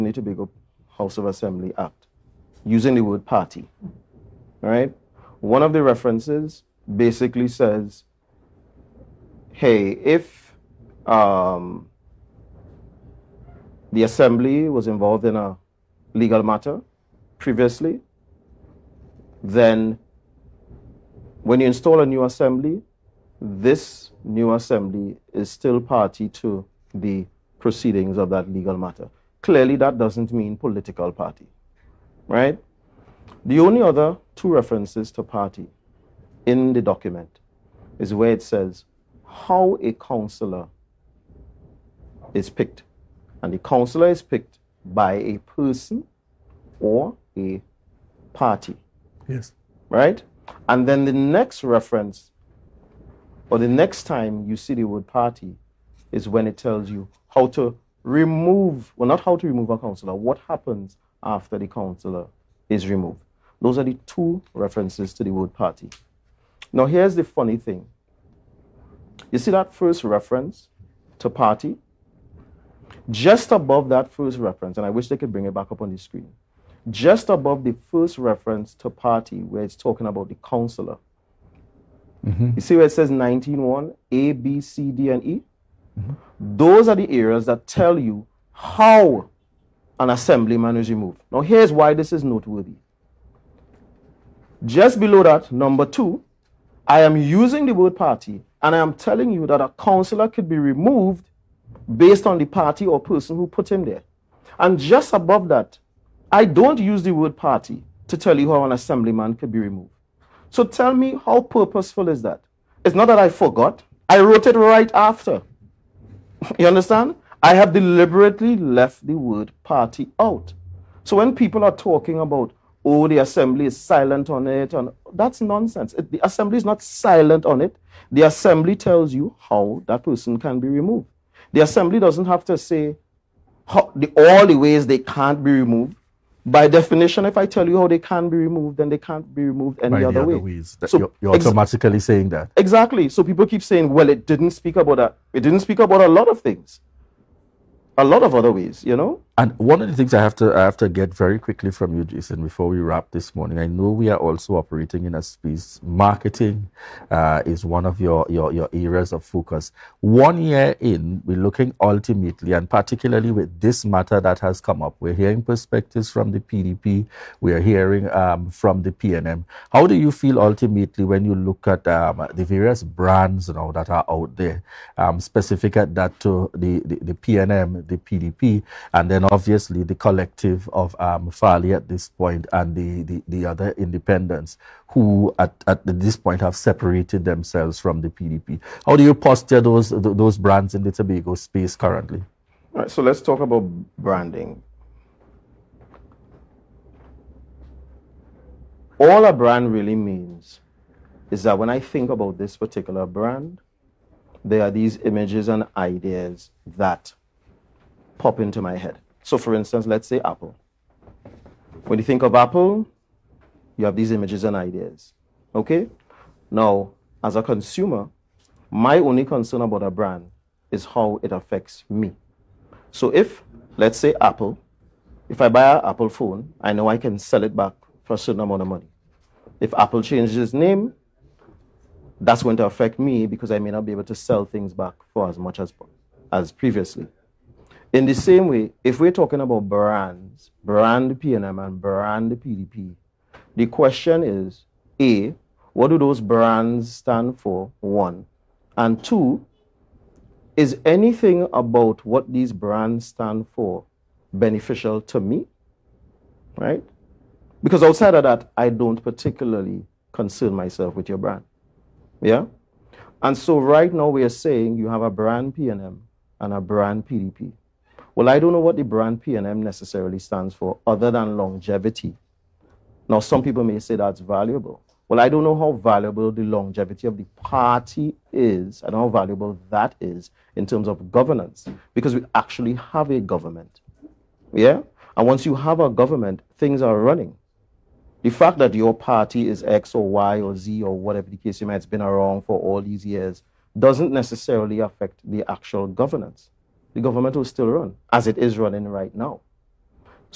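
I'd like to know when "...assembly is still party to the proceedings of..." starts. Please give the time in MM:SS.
00:24.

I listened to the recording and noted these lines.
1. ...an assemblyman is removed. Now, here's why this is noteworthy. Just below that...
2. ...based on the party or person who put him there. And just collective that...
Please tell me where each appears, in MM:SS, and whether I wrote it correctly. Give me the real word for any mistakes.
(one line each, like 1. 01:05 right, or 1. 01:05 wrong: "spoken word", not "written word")
1. 01:29 right
2. 01:41 wrong: "above", not "collective".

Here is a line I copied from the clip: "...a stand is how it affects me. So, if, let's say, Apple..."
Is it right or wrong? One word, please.
wrong.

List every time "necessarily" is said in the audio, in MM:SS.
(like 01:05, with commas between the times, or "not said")
04:29, 04:54.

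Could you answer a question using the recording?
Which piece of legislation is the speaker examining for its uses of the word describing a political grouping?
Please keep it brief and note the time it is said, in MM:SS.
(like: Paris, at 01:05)
Tobago House of Assembly Act, at 00:00.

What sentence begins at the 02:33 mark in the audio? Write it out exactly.
I know we are also operating in a space.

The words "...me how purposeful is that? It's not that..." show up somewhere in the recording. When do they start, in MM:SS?
01:50.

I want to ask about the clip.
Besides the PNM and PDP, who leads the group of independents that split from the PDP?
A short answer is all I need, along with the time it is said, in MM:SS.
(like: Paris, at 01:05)
Farley, at 03:01.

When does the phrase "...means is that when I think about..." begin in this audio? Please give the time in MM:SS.
03:19.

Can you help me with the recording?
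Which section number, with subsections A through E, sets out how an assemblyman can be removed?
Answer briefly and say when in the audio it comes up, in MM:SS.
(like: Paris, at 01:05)
19.1, at 01:23.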